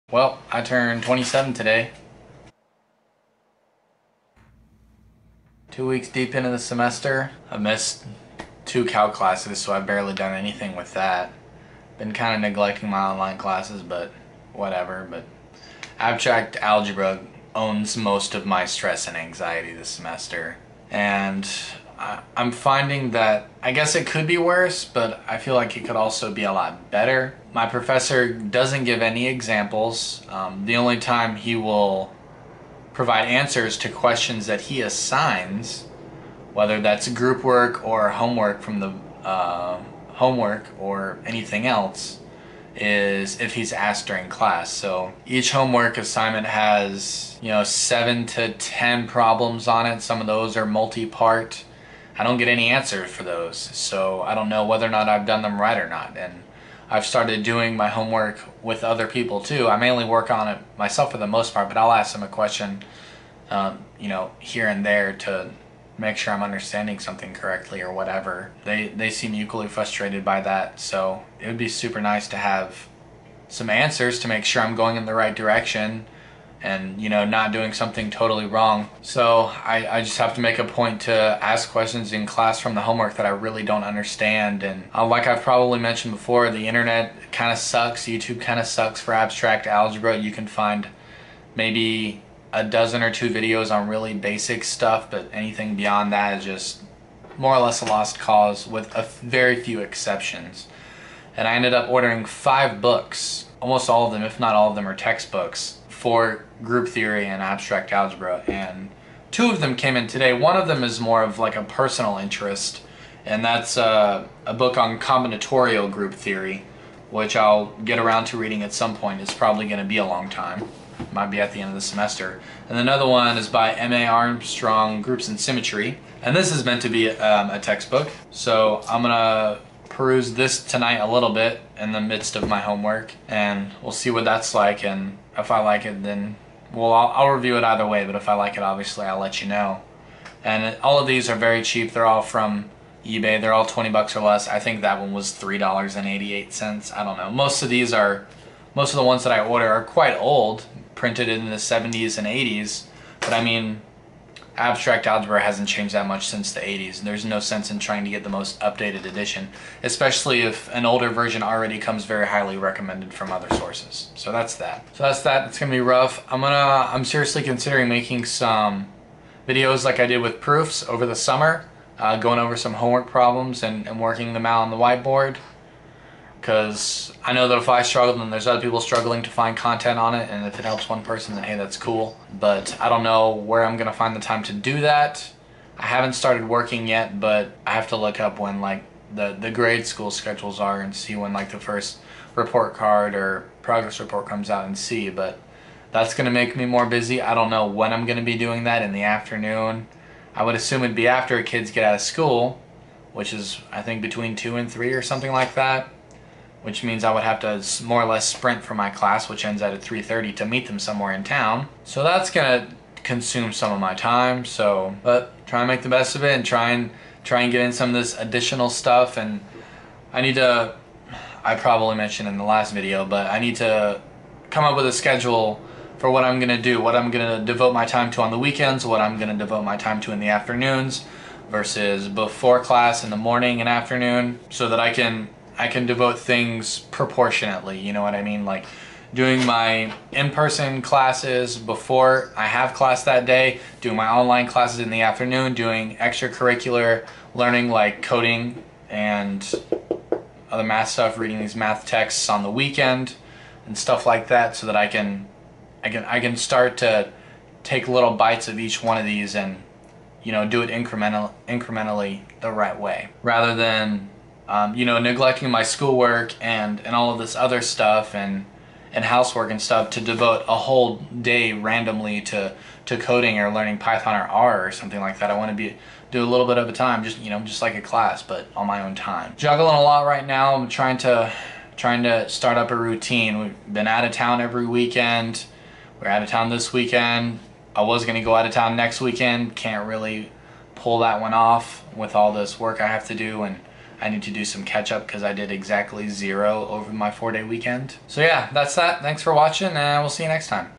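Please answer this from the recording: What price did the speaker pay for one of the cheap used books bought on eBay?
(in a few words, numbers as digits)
$3.88.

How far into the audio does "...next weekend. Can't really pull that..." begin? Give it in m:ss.
4:48.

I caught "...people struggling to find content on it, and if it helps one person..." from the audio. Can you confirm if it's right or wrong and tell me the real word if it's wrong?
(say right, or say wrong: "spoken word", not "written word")
right.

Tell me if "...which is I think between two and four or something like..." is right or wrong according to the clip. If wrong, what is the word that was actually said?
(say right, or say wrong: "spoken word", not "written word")
wrong: "three", not "four".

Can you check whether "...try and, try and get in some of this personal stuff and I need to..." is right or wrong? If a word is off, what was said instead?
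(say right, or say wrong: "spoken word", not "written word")
wrong: "additional", not "personal".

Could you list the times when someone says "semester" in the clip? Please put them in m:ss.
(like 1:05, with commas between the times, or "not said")
0:06, 0:19, 2:01.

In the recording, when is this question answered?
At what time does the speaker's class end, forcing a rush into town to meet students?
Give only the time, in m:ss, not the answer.
3:29.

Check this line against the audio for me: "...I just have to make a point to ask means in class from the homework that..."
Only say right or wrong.
wrong.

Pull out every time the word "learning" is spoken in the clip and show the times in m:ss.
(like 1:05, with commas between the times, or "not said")
4:07, 4:33.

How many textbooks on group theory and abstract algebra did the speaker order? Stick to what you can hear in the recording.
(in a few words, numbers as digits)
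5.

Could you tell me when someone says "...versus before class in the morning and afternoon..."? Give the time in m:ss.
3:51.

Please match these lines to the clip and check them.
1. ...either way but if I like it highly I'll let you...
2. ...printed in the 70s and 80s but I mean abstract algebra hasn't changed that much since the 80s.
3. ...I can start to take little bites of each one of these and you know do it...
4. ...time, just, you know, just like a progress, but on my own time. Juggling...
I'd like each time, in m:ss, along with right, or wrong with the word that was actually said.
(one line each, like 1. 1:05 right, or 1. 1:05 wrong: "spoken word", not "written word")
1. 2:17 wrong: "obviously", not "highly"
2. 2:30 right
3. 4:16 right
4. 4:36 wrong: "class", not "progress".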